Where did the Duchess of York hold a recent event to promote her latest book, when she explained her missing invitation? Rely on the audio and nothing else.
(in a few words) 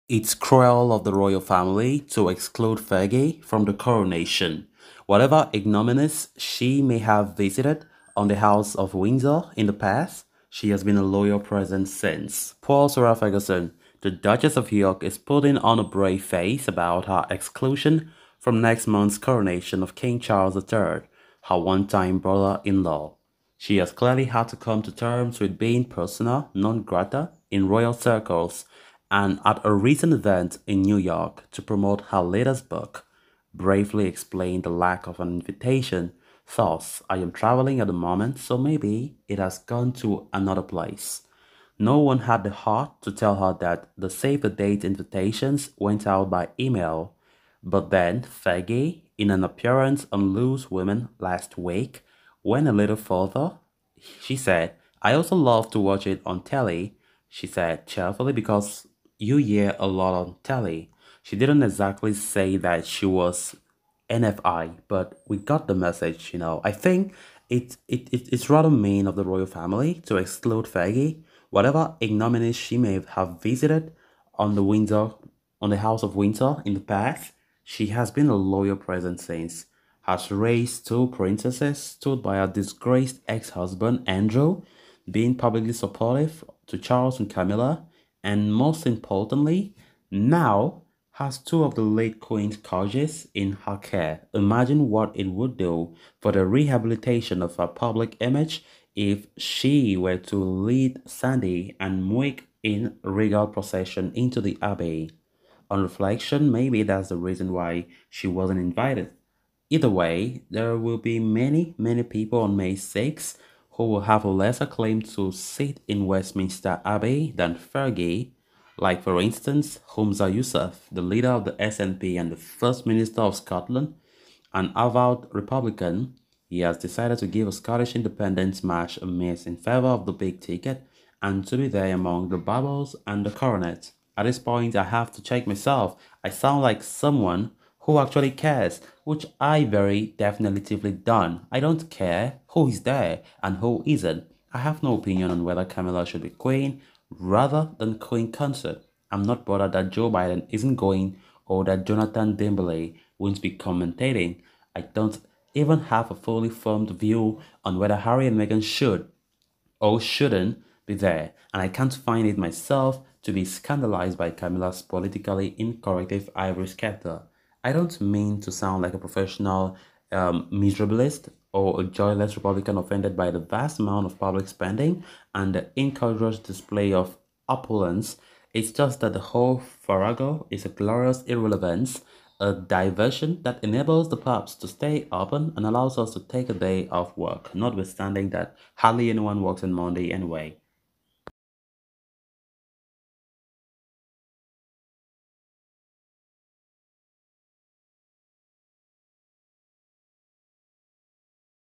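New York.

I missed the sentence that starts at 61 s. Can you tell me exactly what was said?
She didn't exactly say that she was NFI, but we got the message, you know.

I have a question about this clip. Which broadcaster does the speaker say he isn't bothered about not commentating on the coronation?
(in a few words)
Jonathan Dimbleby.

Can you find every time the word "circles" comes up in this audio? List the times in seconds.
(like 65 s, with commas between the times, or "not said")
27 s.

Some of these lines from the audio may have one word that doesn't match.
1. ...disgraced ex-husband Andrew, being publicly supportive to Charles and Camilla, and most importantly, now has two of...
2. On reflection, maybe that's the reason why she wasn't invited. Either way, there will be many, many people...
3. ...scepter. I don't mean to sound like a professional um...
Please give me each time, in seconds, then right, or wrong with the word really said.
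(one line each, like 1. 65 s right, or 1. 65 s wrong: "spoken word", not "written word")
1. 82 s right
2. 105 s right
3. 166 s right.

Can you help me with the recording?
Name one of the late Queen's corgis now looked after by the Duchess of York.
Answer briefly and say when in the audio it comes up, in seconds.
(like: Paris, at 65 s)
Sandy, at 101 s.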